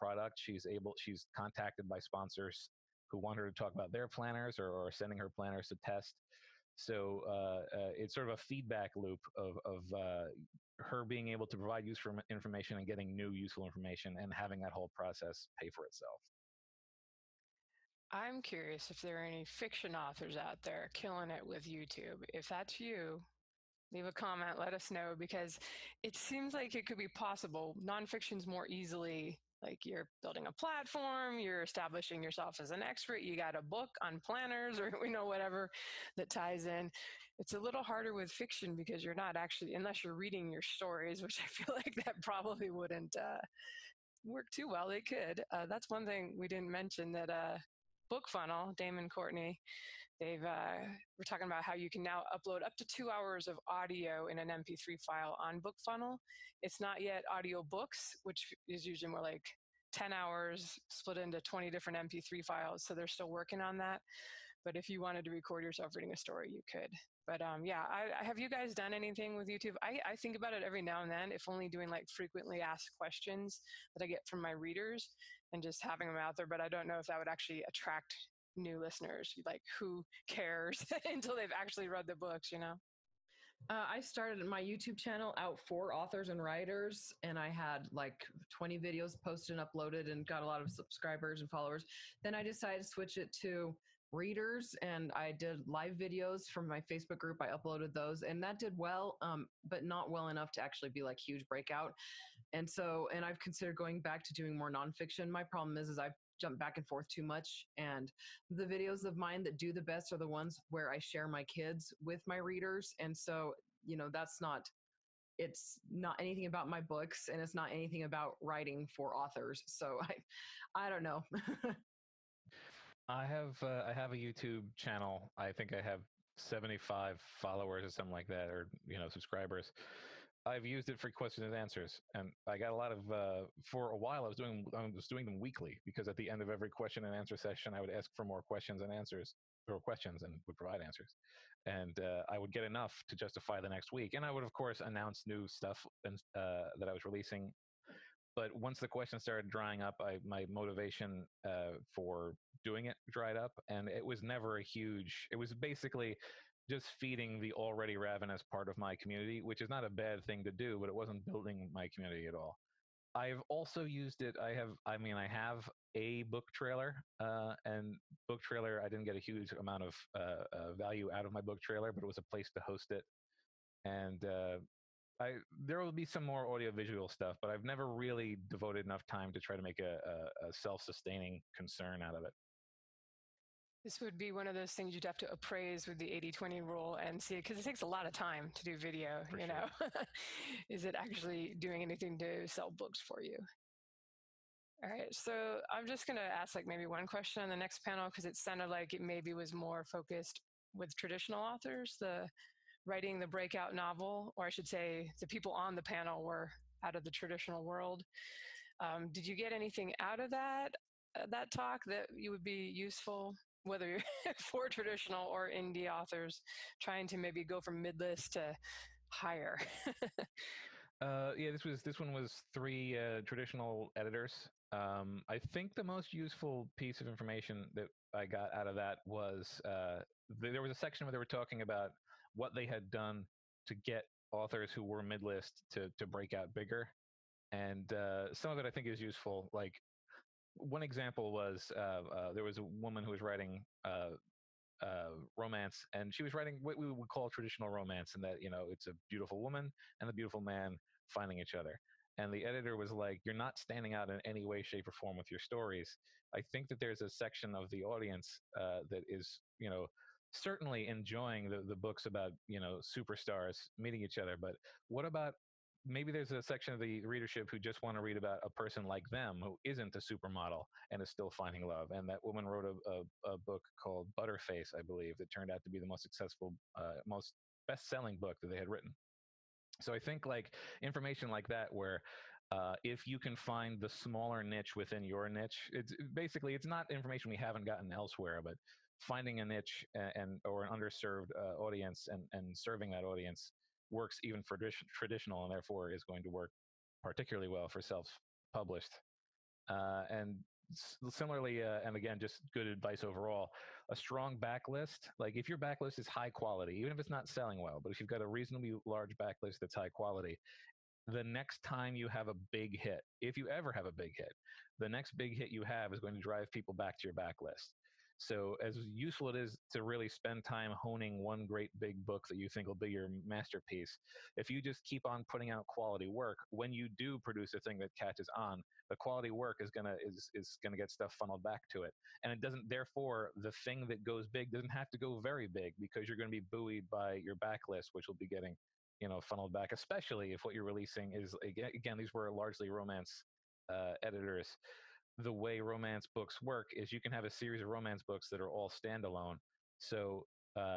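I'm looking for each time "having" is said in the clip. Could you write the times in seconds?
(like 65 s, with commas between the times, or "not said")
14 s, 75 s.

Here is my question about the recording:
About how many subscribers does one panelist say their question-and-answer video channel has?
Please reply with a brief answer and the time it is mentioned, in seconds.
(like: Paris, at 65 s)
75, at 126 s.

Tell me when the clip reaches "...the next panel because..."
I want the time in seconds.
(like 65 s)
197 s.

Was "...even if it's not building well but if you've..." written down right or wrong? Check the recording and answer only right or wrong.
wrong.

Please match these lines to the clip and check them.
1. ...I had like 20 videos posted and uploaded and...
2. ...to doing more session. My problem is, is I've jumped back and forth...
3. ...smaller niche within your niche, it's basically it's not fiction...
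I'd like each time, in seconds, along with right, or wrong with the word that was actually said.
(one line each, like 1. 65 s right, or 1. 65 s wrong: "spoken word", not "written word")
1. 87 s right
2. 104 s wrong: "nonfiction", not "session"
3. 283 s wrong: "information", not "fiction".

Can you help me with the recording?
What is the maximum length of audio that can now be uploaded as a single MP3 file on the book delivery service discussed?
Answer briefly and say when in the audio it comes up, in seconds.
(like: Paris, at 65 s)
2 hours, at 52 s.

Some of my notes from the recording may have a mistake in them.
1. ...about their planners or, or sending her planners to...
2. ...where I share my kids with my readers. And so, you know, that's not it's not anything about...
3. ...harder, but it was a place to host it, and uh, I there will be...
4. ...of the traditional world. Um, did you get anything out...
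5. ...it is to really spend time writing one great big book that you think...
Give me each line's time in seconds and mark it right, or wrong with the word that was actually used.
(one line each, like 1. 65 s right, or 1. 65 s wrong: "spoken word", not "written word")
1. 3 s right
2. 110 s right
3. 171 s wrong: "trailer", not "harder"
4. 206 s right
5. 319 s wrong: "honing", not "writing".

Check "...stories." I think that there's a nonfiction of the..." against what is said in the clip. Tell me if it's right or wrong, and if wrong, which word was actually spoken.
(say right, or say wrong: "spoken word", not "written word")
wrong: "section", not "nonfiction".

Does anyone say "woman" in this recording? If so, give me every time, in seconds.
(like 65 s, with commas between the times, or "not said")
242 s, 249 s, 272 s.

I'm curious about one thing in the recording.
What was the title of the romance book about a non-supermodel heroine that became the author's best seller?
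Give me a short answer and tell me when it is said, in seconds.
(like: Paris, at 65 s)
Butterface, at 274 s.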